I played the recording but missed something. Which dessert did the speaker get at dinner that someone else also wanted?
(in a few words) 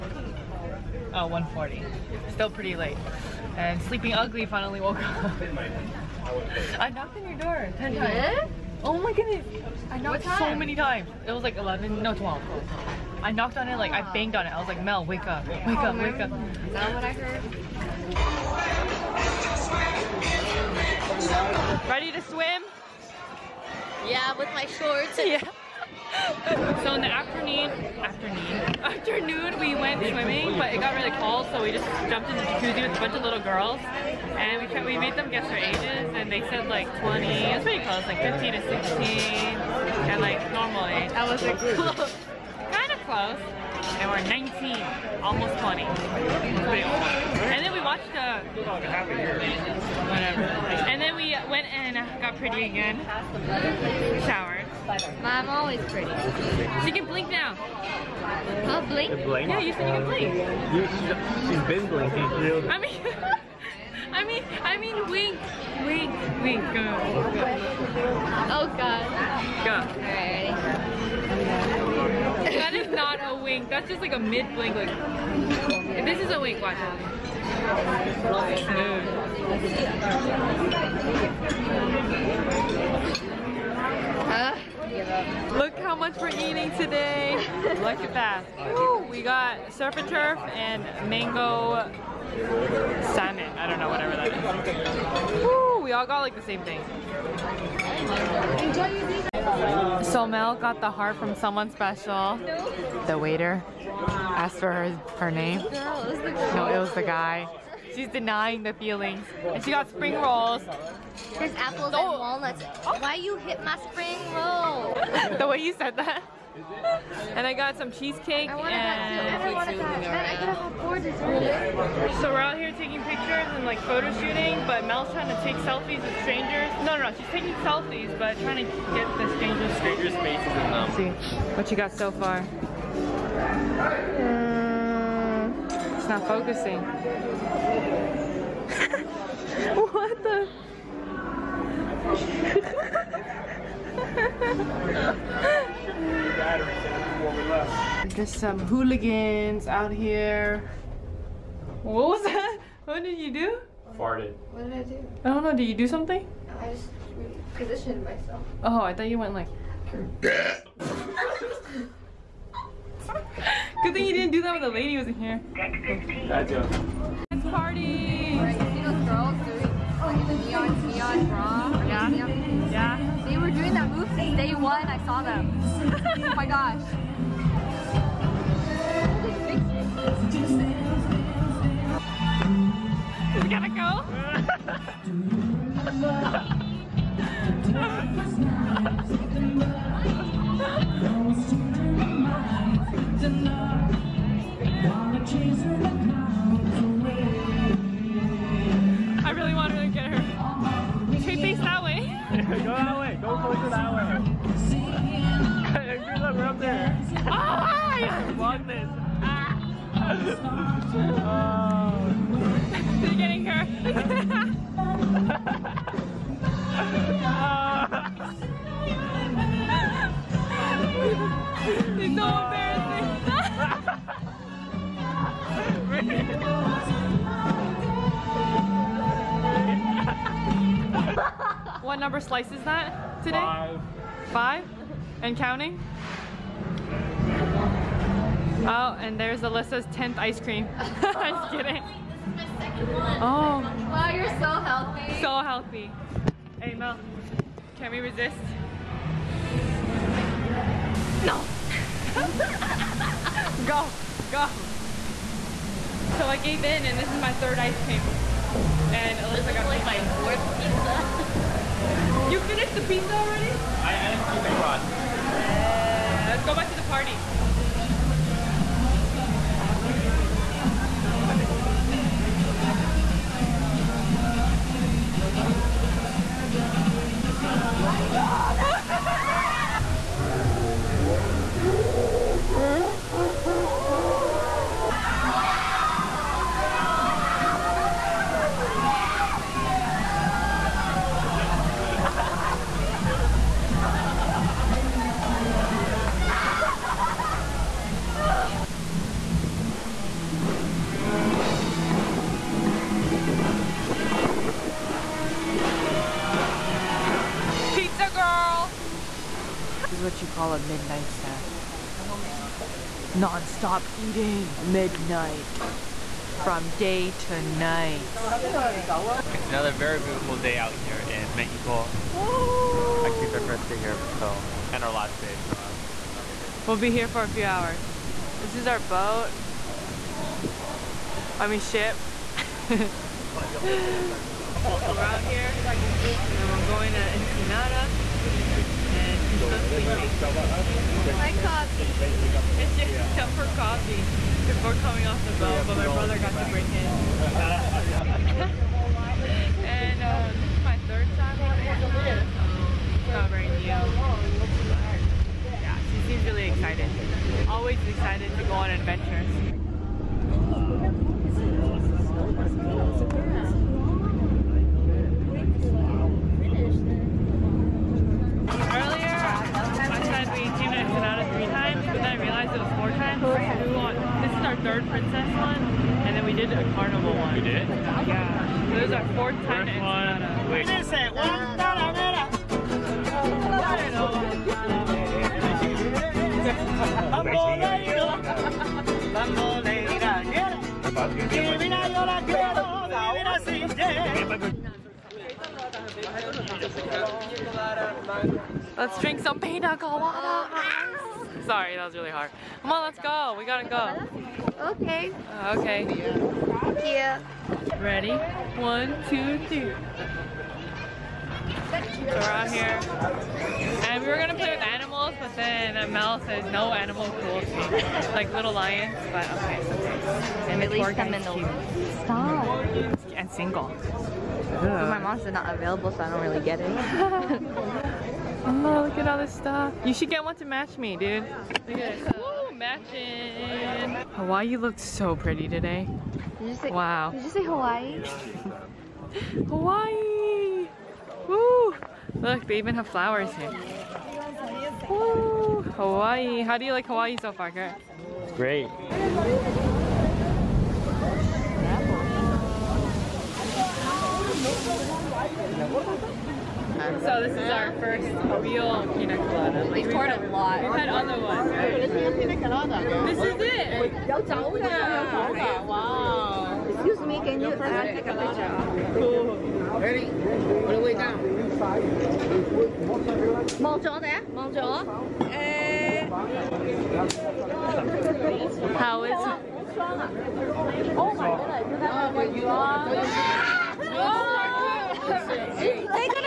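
Cheesecake.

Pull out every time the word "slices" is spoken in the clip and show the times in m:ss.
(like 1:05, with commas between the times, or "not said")
3:52.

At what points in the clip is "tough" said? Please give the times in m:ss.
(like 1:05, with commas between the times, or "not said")
5:43.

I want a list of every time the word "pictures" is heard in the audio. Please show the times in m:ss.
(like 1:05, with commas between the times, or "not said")
2:03, 7:48.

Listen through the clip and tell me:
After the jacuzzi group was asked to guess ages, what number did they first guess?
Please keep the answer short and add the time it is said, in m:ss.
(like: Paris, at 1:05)
20, at 0:36.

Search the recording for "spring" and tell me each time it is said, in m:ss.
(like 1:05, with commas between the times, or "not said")
1:49, 1:53.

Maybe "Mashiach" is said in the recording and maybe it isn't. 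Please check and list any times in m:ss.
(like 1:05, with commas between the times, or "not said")
not said.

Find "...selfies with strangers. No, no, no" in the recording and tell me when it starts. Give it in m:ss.
2:05.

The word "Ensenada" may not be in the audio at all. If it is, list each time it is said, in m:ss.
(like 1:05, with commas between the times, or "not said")
5:37.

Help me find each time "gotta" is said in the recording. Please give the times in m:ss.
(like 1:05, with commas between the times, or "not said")
3:03, 6:43.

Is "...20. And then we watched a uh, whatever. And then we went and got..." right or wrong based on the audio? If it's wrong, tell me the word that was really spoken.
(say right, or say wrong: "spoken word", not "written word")
right.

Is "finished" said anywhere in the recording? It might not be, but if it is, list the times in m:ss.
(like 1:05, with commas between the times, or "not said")
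4:22.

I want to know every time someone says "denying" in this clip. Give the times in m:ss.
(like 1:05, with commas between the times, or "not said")
1:48.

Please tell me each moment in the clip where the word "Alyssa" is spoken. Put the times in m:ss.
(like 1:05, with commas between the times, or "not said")
3:59, 4:19.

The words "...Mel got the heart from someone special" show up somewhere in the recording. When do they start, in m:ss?
1:40.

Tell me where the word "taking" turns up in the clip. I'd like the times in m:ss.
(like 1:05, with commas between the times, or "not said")
2:02, 2:07.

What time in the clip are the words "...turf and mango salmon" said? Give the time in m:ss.
1:30.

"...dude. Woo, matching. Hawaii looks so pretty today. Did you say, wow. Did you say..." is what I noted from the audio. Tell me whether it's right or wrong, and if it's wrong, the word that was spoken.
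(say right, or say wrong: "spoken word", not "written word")
right.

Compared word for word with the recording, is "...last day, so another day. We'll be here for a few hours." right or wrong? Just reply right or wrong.
right.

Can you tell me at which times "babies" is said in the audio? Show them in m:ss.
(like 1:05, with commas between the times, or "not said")
not said.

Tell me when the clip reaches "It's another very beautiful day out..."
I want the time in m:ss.
5:19.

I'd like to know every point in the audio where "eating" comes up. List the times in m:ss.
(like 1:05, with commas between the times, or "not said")
1:26, 5:13.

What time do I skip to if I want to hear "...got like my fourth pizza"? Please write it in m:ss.
4:19.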